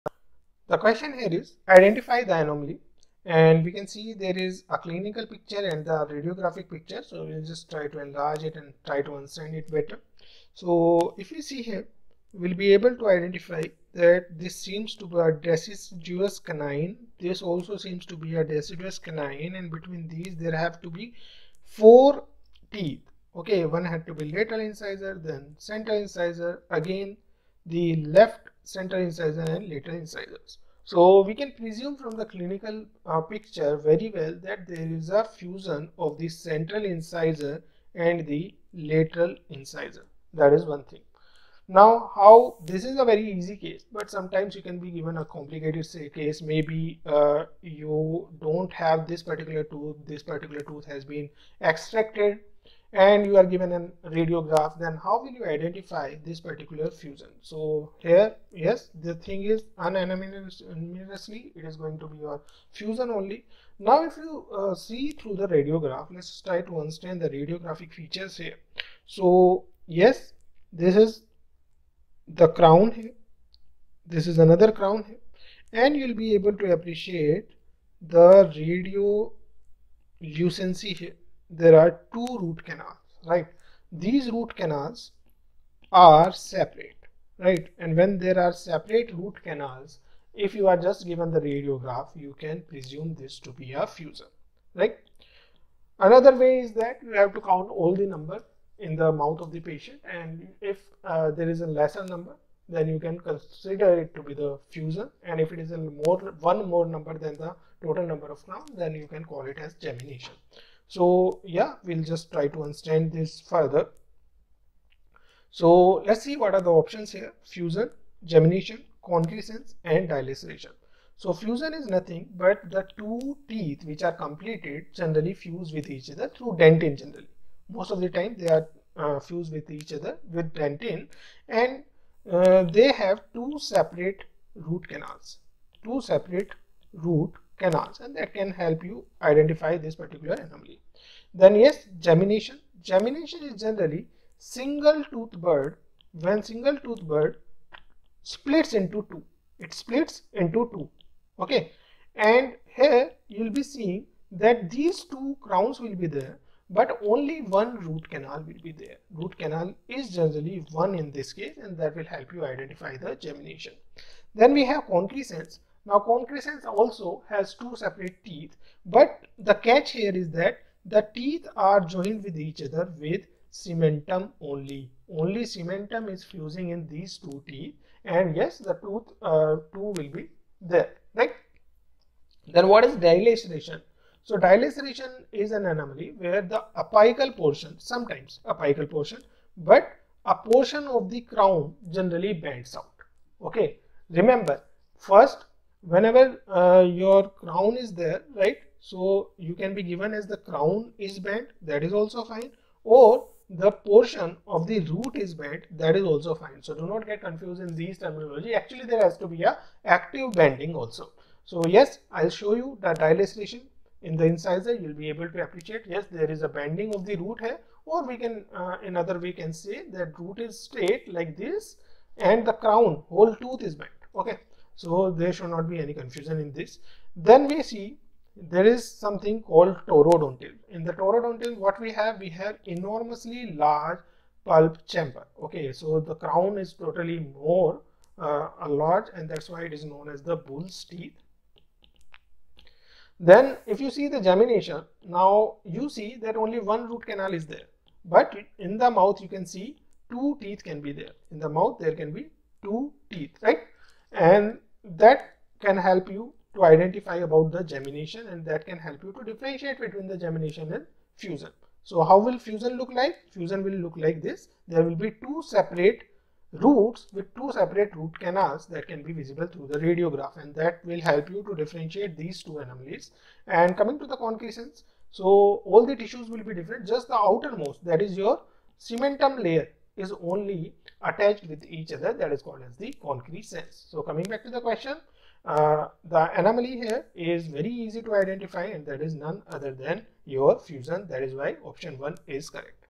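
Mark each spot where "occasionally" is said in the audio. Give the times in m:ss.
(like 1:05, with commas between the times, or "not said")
not said.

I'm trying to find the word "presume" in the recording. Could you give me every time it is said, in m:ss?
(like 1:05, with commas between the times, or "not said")
0:31, 1:32.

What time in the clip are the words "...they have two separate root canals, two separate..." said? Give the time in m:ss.
2:12.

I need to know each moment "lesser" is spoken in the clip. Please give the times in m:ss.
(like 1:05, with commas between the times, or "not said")
1:41.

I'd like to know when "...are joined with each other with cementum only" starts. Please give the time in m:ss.
2:51.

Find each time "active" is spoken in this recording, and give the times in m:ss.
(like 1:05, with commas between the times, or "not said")
3:29.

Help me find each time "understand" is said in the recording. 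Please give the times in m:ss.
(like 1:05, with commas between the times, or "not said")
0:09, 1:06, 1:52.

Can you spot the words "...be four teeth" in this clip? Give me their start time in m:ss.
0:20.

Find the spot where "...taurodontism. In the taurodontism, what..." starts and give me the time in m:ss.
3:49.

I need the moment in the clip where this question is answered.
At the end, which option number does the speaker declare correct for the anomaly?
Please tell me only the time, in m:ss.
4:51.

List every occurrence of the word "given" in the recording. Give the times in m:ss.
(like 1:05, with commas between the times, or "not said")
0:44, 0:53, 1:31, 3:19.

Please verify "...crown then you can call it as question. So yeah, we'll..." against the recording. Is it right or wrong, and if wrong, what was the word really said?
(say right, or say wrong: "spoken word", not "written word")
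wrong: "gemination", not "question".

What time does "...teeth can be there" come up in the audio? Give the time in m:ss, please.
4:10.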